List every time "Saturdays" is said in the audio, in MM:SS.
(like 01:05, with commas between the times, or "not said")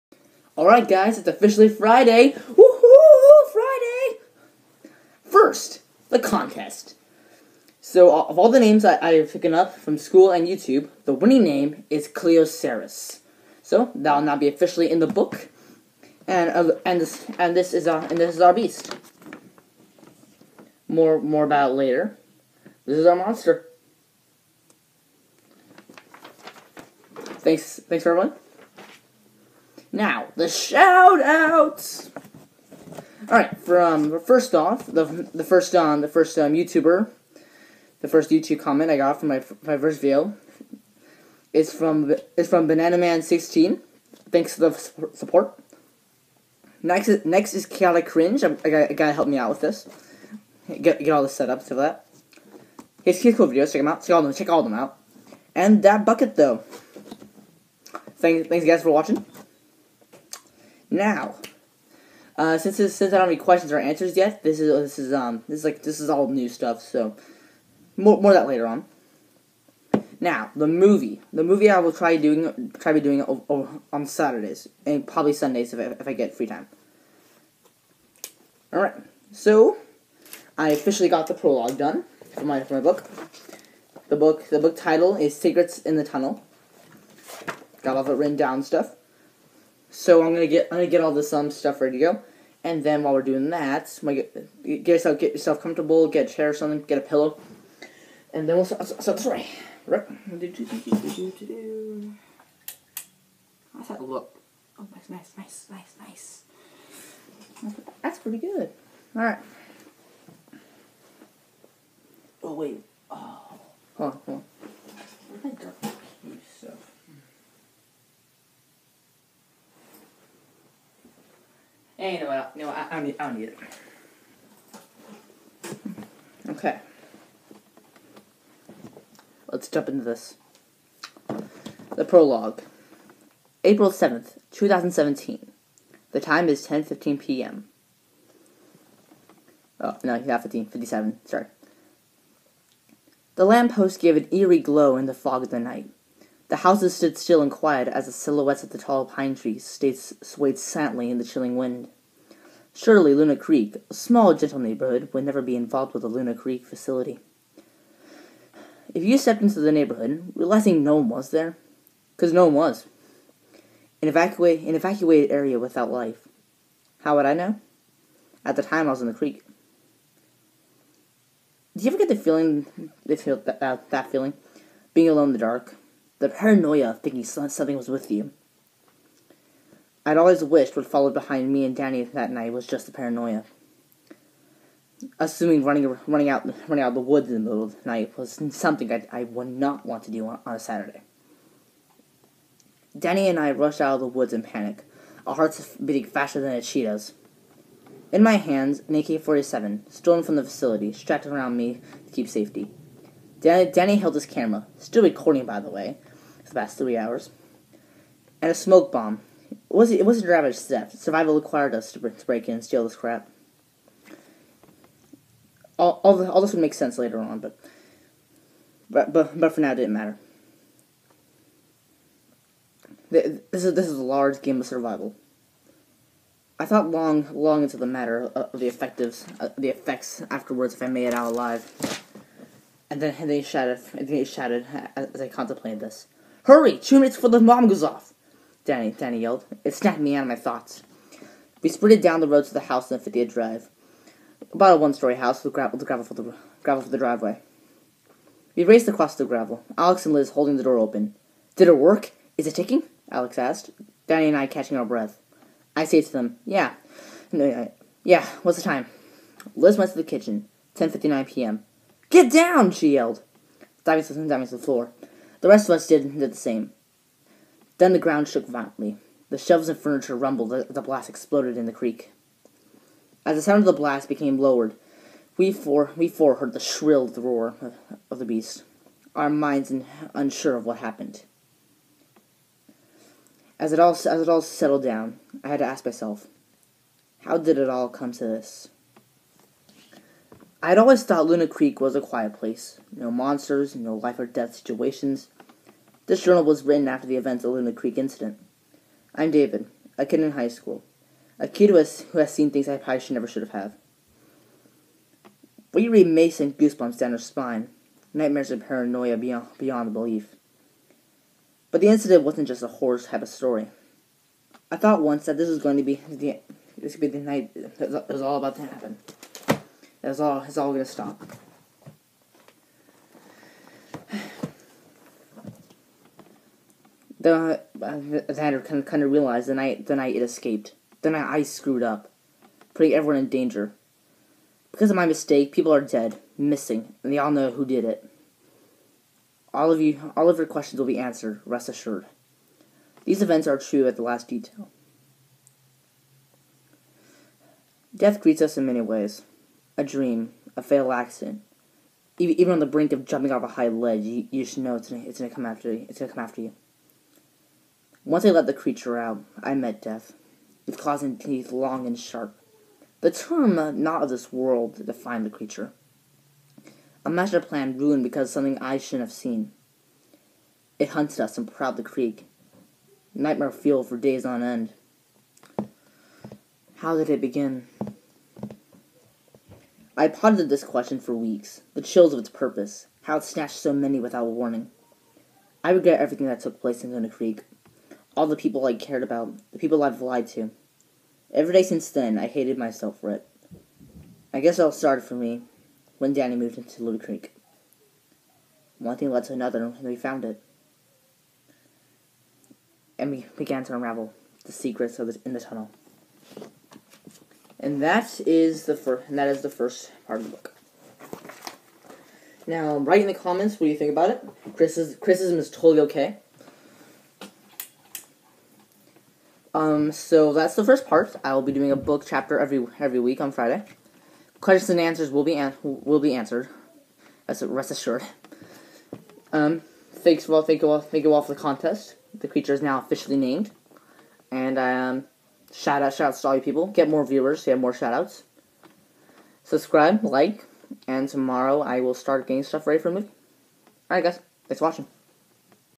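01:14, 03:10.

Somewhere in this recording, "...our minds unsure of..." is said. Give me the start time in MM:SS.
04:39.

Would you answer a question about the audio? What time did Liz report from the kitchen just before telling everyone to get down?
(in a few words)
10:59 p.m.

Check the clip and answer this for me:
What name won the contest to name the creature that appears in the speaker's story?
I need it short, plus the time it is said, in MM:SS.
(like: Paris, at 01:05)
Cleocerus, at 00:12.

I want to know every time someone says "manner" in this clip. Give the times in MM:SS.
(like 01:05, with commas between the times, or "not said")
not said.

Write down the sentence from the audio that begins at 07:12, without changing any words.
The creature is now officially named, and um, shout out, shout outs to all you people.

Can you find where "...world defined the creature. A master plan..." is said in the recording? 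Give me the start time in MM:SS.
06:04.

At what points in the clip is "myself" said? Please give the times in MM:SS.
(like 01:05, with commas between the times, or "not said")
04:45, 06:32.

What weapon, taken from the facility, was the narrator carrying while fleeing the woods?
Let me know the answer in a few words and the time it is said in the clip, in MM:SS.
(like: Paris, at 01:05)
AK 47, at 03:18.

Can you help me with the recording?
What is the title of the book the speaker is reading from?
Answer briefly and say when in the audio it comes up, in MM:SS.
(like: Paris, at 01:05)
Secrets in the Tunnel, at 01:25.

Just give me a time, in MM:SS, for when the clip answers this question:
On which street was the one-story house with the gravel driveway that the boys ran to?
04:02.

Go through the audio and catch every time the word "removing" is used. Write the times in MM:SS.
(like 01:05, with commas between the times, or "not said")
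not said.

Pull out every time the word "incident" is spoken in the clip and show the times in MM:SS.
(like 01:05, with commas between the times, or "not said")
04:57, 05:11.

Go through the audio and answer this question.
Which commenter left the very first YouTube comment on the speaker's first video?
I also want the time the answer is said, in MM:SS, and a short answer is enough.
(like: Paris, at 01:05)
Banana Man 16, at 00:42.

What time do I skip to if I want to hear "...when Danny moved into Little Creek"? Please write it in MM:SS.
06:35.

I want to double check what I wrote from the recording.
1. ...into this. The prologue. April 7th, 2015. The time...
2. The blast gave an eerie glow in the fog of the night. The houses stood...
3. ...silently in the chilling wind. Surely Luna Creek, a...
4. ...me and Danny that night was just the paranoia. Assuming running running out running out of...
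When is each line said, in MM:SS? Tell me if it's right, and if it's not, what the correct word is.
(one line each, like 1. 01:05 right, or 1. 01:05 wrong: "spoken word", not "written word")
1. 02:09 wrong: "2017", not "2015"
2. 02:23 wrong: "lamppost", not "blast"
3. 02:30 right
4. 03:01 right.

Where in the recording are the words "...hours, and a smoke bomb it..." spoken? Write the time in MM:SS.
03:26.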